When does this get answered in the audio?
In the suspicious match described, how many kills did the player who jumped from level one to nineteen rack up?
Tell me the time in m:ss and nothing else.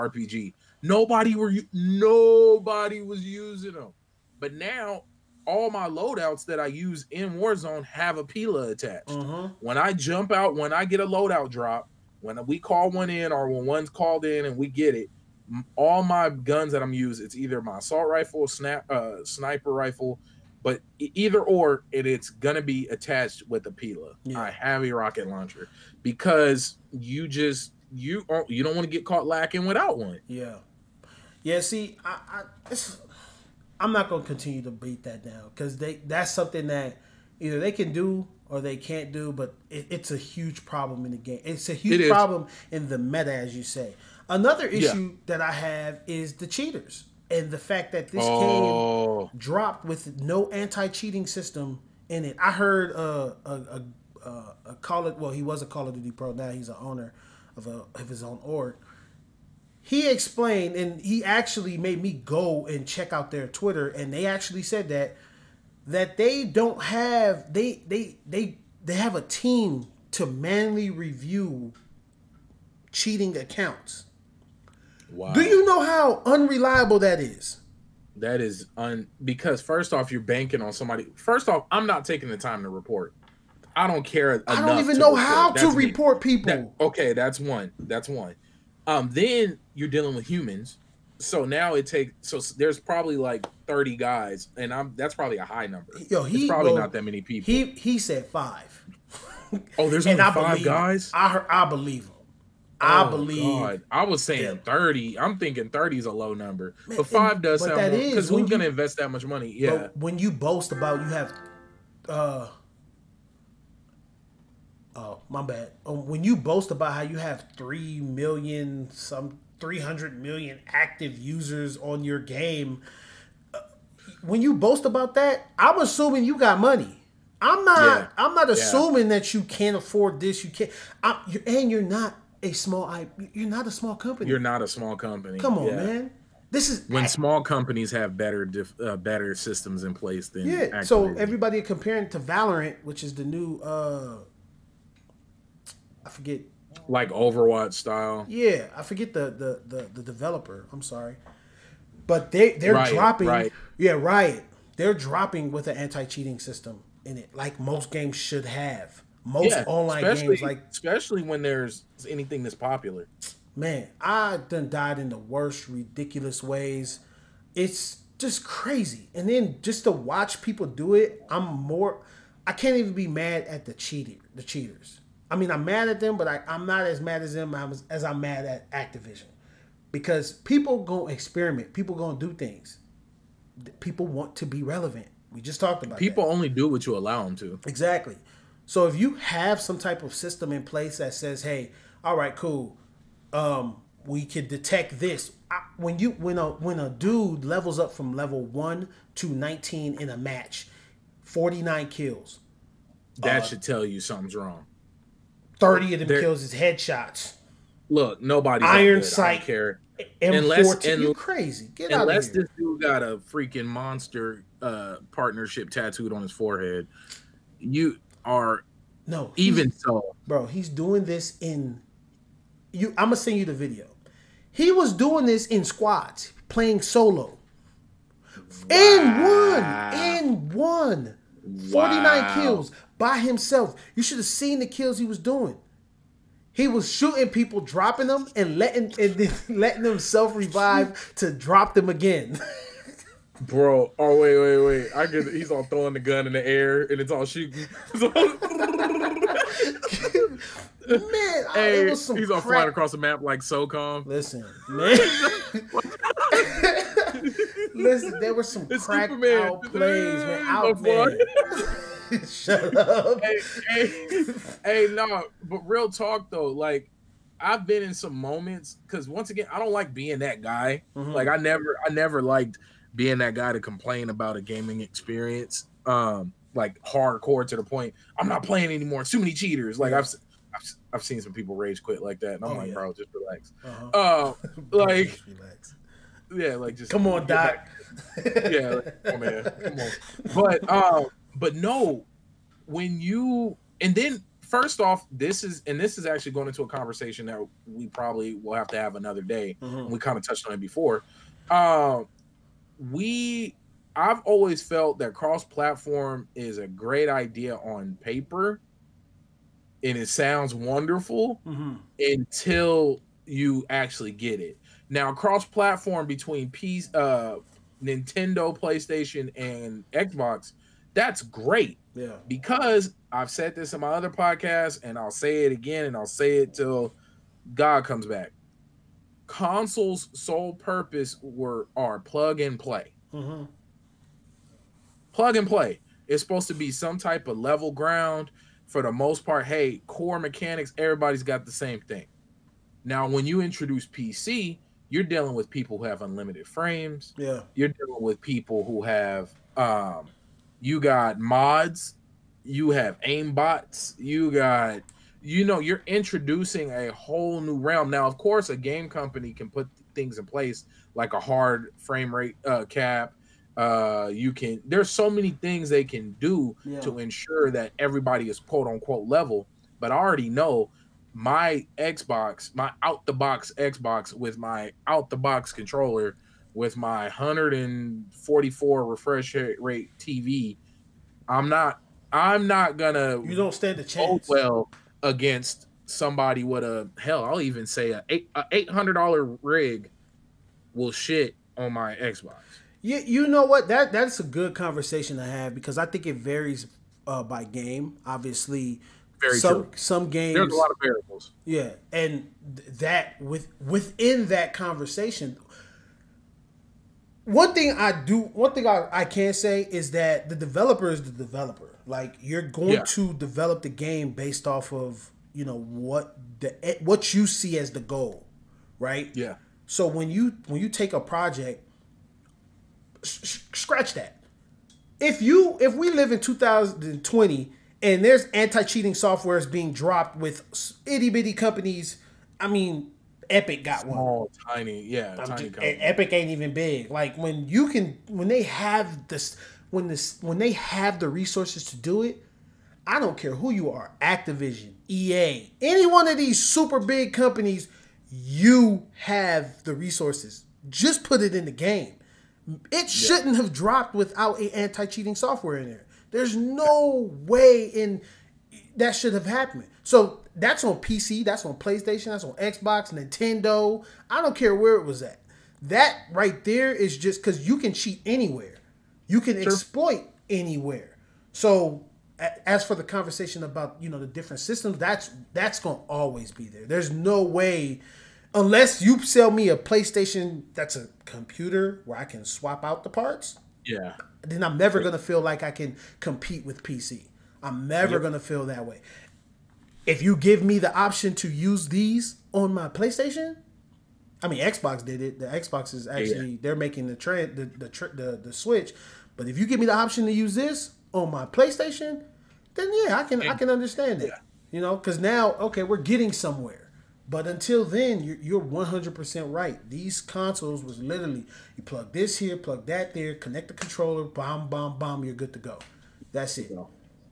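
3:21.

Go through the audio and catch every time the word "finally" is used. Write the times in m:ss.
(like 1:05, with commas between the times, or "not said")
not said.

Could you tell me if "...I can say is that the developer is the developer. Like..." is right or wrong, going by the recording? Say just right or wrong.
right.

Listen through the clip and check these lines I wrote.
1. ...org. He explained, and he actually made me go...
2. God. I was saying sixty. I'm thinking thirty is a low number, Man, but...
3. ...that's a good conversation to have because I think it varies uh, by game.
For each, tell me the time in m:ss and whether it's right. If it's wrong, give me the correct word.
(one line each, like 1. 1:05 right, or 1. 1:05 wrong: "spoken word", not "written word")
1. 0:58 right
2. 1:43 wrong: "thirty", not "sixty"
3. 6:33 right.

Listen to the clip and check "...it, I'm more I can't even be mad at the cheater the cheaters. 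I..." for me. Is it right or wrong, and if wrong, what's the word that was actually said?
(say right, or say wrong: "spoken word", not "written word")
right.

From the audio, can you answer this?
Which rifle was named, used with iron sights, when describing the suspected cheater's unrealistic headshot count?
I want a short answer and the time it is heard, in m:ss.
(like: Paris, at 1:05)
M14, at 3:30.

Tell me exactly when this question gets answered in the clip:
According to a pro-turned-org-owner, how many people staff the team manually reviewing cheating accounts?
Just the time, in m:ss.
1:37.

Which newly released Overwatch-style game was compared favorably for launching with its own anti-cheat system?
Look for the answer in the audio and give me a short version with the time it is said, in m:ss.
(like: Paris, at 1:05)
Valorant, at 2:22.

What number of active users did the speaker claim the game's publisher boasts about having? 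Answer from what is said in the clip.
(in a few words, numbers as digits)
300 million.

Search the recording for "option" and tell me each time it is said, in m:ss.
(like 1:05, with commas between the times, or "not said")
8:10, 8:19.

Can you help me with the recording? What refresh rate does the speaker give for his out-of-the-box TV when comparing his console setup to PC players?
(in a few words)
144.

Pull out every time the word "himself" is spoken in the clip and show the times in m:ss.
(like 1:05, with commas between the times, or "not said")
3:53, 3:59.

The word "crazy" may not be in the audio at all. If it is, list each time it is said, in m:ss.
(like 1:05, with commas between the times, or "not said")
2:48, 3:31.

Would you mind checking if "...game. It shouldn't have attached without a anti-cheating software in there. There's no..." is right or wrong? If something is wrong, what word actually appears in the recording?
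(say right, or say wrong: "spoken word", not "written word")
wrong: "dropped", not "attached".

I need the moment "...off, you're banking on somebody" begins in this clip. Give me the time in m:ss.
1:19.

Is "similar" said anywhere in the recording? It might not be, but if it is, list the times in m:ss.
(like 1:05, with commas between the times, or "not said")
not said.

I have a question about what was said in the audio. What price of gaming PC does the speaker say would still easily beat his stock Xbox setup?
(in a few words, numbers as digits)
$800.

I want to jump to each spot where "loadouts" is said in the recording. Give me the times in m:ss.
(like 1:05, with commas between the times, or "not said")
0:05, 0:11.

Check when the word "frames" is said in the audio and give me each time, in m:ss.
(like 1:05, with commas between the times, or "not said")
5:46, 6:01.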